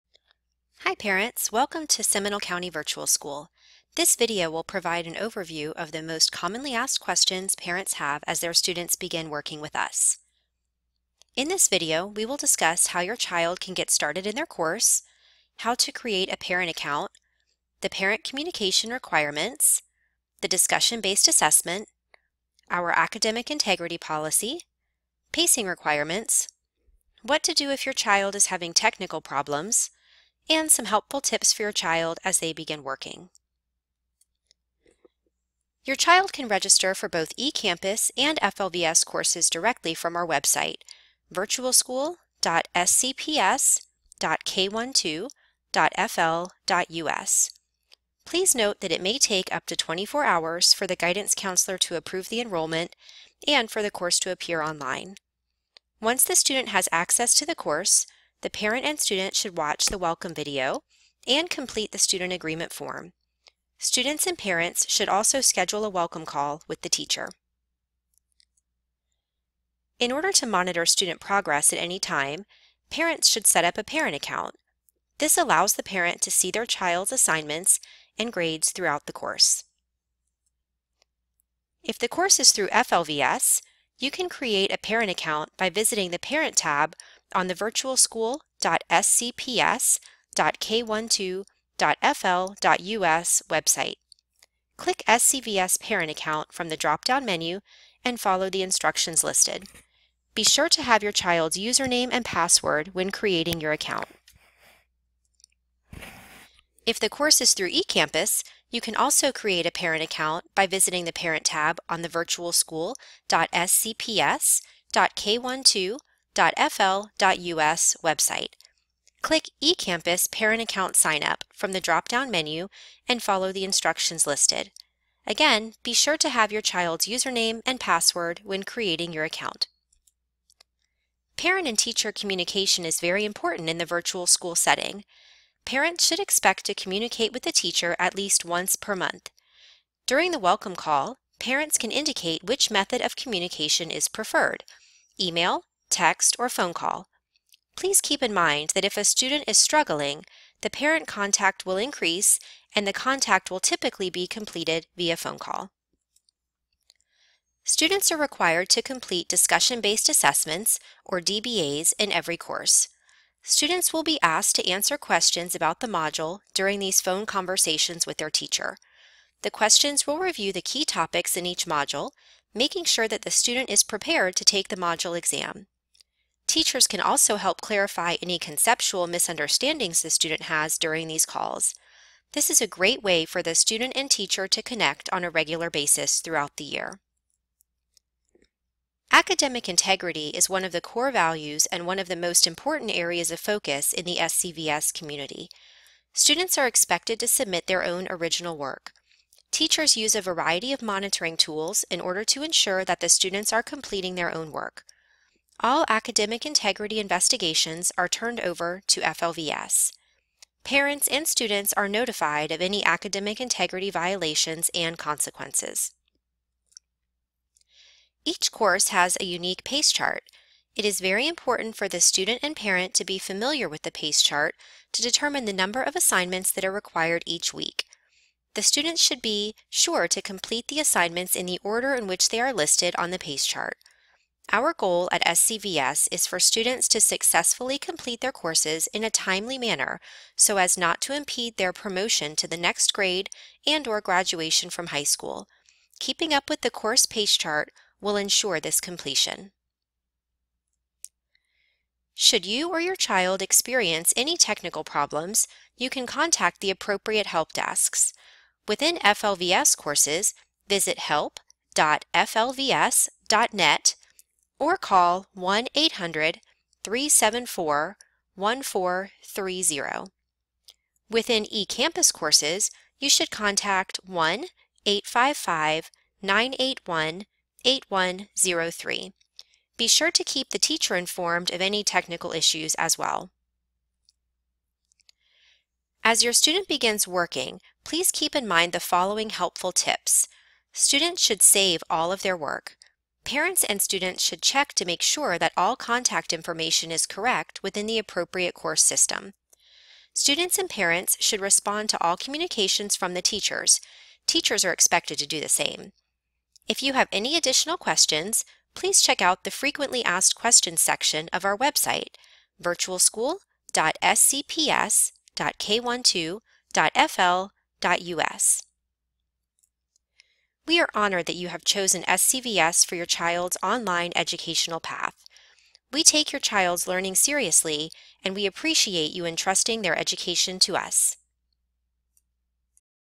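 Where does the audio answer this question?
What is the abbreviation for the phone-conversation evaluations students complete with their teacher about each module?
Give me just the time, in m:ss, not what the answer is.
2:41.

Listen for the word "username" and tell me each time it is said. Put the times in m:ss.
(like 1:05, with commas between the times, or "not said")
1:41, 2:07.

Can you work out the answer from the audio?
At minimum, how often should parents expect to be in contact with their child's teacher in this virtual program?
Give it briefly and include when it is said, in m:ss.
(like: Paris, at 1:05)
Once per month, at 2:18.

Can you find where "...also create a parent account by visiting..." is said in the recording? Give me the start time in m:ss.
1:48.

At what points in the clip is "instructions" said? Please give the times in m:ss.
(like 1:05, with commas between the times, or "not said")
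1:38, 2:03.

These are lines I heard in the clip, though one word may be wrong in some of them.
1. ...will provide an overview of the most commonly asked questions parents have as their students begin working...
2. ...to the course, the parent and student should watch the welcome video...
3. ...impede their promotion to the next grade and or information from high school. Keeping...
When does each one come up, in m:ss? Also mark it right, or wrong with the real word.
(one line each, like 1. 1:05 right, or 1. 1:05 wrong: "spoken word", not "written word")
1. 0:04 right
2. 0:57 right
3. 4:01 wrong: "graduation", not "information".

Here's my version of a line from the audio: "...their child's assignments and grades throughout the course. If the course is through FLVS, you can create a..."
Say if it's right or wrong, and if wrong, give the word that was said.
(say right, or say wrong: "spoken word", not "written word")
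right.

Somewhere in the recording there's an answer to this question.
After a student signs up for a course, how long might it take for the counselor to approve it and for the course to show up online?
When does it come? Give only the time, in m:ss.
0:49.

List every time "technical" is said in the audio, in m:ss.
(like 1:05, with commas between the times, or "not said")
0:28, 4:14, 4:41.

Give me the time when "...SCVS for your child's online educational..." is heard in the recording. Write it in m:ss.
5:22.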